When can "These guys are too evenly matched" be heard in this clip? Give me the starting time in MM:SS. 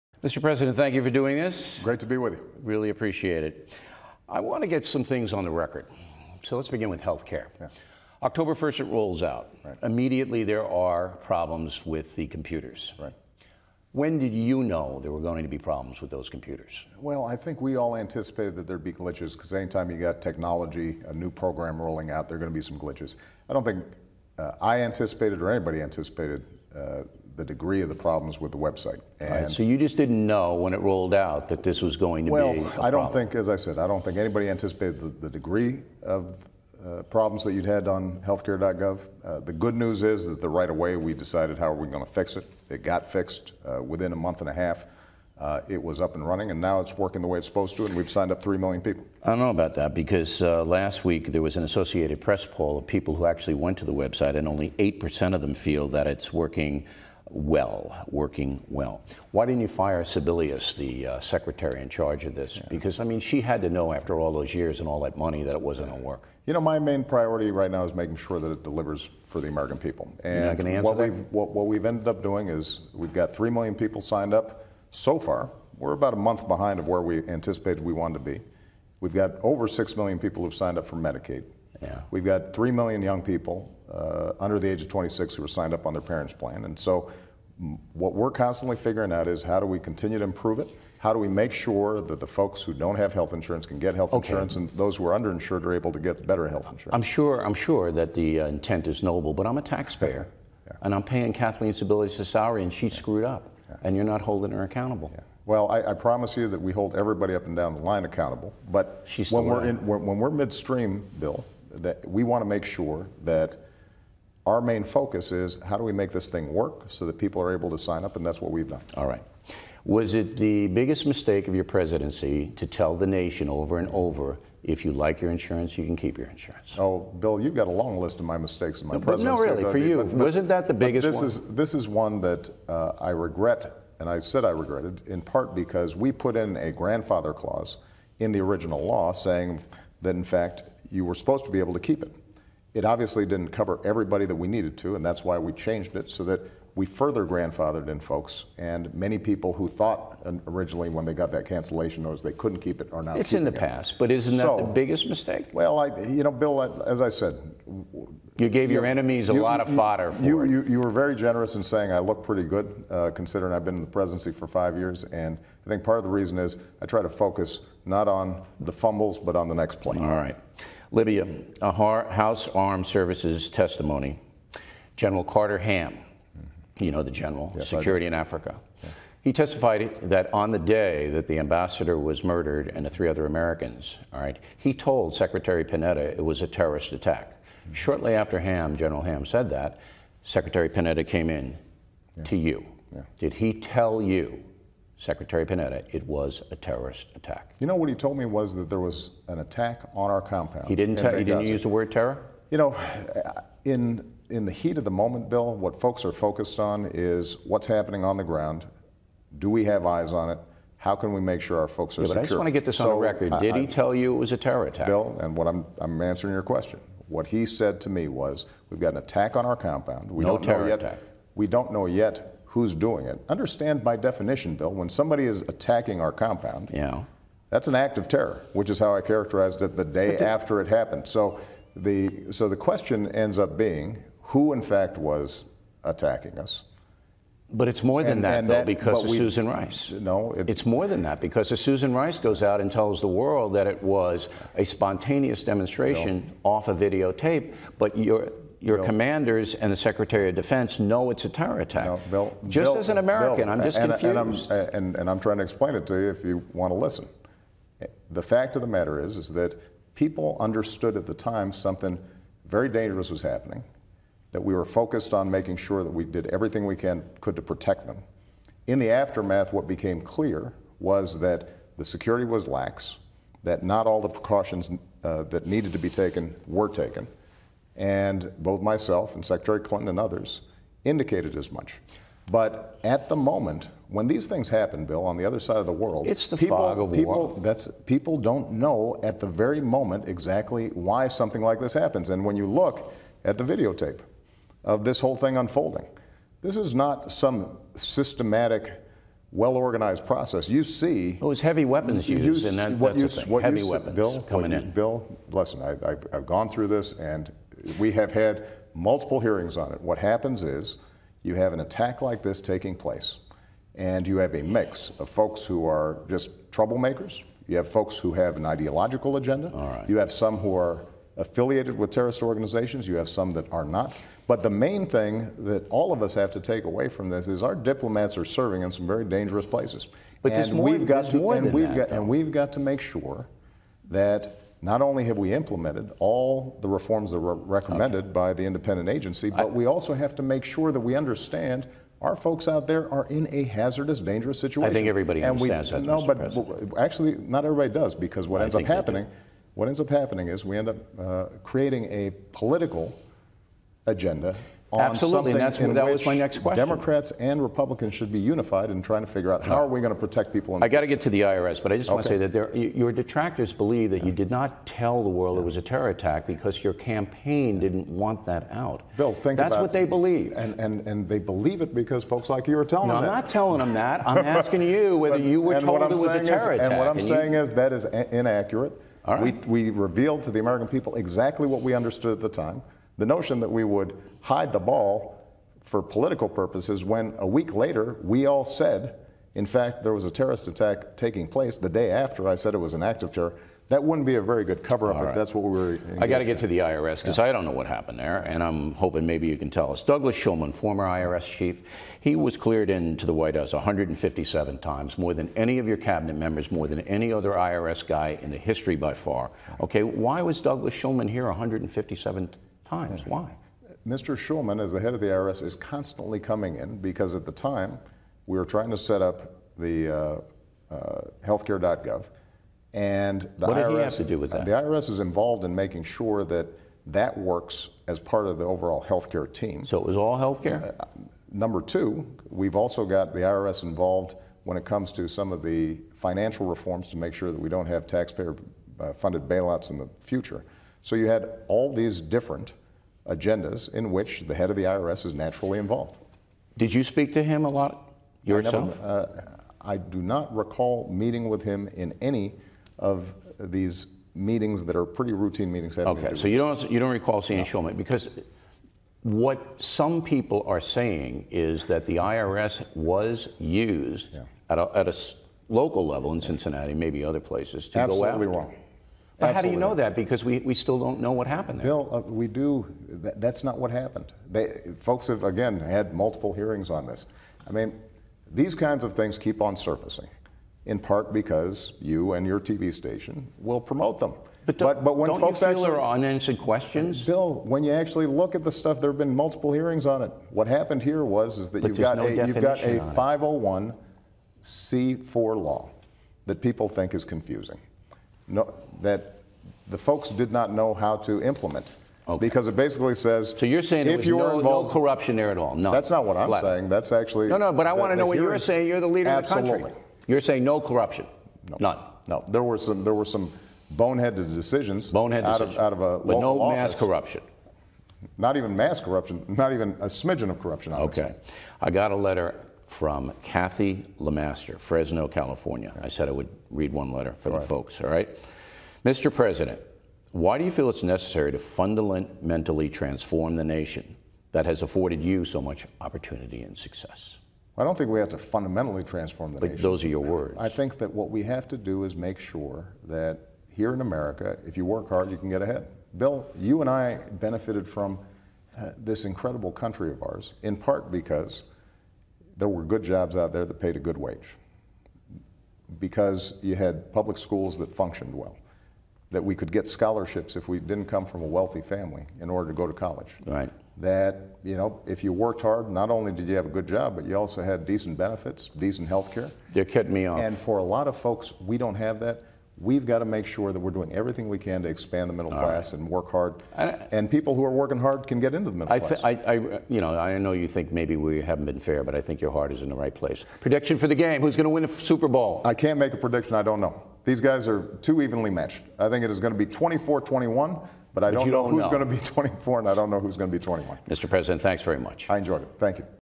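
09:47.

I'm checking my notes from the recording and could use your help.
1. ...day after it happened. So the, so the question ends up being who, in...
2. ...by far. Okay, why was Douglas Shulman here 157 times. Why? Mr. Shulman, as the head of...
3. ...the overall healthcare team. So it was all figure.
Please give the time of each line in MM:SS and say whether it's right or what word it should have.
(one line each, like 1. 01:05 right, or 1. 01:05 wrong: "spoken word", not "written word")
1. 03:49 right
2. 06:48 right
3. 07:08 wrong: "healthcare", not "figure".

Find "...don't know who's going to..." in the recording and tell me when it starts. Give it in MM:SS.
09:52.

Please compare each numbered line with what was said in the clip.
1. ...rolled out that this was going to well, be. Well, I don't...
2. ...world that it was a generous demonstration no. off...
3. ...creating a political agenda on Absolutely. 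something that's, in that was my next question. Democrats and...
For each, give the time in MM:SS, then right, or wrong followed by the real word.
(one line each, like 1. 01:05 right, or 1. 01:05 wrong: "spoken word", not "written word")
1. 00:30 right
2. 04:03 wrong: "spontaneous", not "generous"
3. 05:51 right.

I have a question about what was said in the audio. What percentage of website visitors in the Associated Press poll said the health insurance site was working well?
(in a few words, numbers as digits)
8%.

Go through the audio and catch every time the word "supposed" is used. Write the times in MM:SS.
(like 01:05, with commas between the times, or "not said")
00:47, 02:21.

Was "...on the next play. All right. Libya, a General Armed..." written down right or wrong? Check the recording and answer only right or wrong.
wrong.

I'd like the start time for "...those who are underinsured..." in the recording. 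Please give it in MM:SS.
01:34.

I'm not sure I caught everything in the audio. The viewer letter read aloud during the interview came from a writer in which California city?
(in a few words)
Fresno.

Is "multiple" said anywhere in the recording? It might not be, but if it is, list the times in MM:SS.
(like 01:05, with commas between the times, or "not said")
05:08, 07:55, 08:09.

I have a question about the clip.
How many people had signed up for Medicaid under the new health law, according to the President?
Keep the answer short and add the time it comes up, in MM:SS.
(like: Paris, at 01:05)
over 6 million, at 01:19.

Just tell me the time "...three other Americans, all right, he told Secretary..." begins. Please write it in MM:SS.
03:02.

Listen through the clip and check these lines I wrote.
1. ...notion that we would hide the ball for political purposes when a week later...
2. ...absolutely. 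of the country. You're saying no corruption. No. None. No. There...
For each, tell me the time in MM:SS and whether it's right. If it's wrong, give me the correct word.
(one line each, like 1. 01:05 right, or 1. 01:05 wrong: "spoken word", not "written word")
1. 06:23 right
2. 08:29 right.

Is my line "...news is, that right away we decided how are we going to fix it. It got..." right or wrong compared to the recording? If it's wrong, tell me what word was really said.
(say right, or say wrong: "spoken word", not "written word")
right.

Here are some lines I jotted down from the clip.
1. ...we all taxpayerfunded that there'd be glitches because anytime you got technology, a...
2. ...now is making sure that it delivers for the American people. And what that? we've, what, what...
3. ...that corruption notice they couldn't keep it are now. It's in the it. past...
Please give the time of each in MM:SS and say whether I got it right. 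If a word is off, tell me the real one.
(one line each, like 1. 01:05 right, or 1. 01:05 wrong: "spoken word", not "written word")
1. 00:17 wrong: "anticipated", not "taxpayerfunded"
2. 01:07 right
3. 02:31 wrong: "cancellation", not "corruption".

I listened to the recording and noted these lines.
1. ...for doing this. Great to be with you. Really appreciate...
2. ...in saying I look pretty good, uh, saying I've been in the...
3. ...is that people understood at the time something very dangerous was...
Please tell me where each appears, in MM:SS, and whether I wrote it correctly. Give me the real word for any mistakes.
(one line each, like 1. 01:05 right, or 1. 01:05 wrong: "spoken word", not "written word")
1. 00:01 right
2. 02:41 wrong: "considering", not "saying"
3. 04:19 right.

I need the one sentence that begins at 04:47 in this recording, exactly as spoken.
That's, people don't know at the very moment exactly why something like this happens.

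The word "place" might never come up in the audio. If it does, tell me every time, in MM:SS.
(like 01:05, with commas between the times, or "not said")
05:12, 05:29, 06:31, 07:47, 09:42.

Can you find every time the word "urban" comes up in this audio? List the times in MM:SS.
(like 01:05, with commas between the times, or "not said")
not said.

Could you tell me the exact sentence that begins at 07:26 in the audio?
Did you speak to him a lot yourself?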